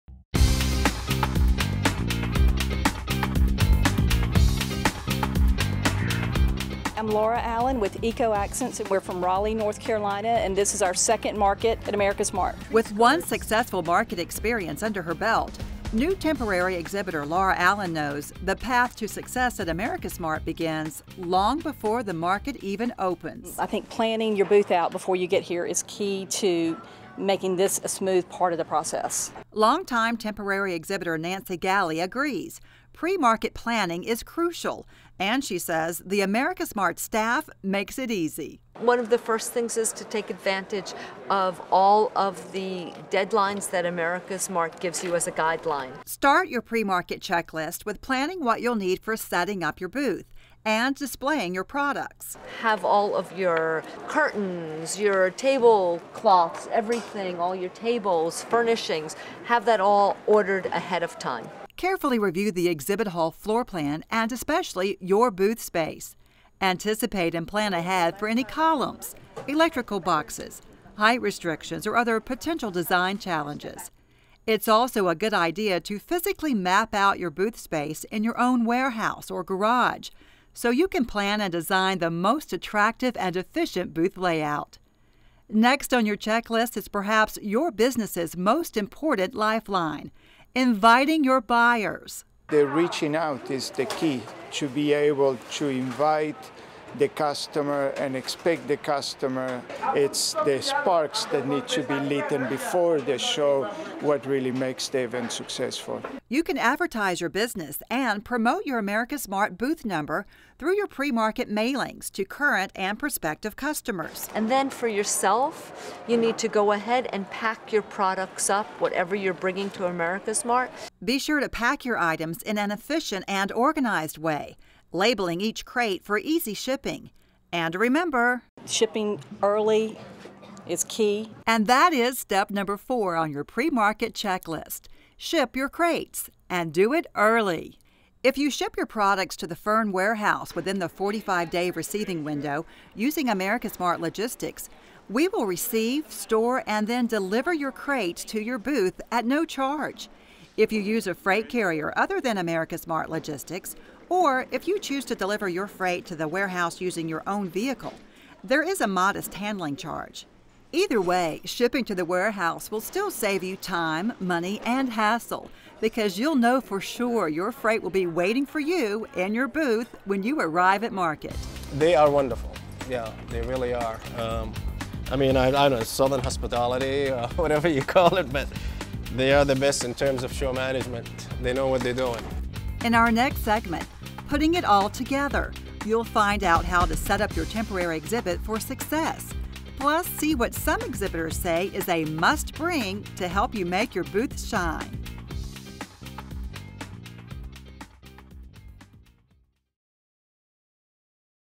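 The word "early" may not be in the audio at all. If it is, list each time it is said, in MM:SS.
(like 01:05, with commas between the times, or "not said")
02:09, 02:17.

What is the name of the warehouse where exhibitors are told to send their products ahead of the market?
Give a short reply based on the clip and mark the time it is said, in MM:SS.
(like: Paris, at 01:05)
Fern, at 02:19.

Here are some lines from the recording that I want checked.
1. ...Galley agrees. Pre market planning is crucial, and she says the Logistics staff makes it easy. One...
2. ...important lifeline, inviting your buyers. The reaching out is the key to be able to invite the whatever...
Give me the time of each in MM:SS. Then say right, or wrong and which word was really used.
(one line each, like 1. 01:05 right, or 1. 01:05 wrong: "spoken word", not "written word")
1. 00:31 wrong: "AmericasMart", not "Logistics"
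2. 01:28 wrong: "customer", not "whatever".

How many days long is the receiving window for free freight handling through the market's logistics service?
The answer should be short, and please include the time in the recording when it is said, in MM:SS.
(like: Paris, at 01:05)
45, at 02:20.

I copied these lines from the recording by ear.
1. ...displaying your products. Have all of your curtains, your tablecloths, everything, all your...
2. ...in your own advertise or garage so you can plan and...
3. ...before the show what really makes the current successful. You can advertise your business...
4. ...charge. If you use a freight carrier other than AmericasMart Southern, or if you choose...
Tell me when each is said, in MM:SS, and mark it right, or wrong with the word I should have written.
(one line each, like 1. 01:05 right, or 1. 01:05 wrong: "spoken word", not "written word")
1. 00:50 right
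2. 01:18 wrong: "warehouse", not "advertise"
3. 01:42 wrong: "event", not "current"
4. 02:29 wrong: "Logistics", not "Southern".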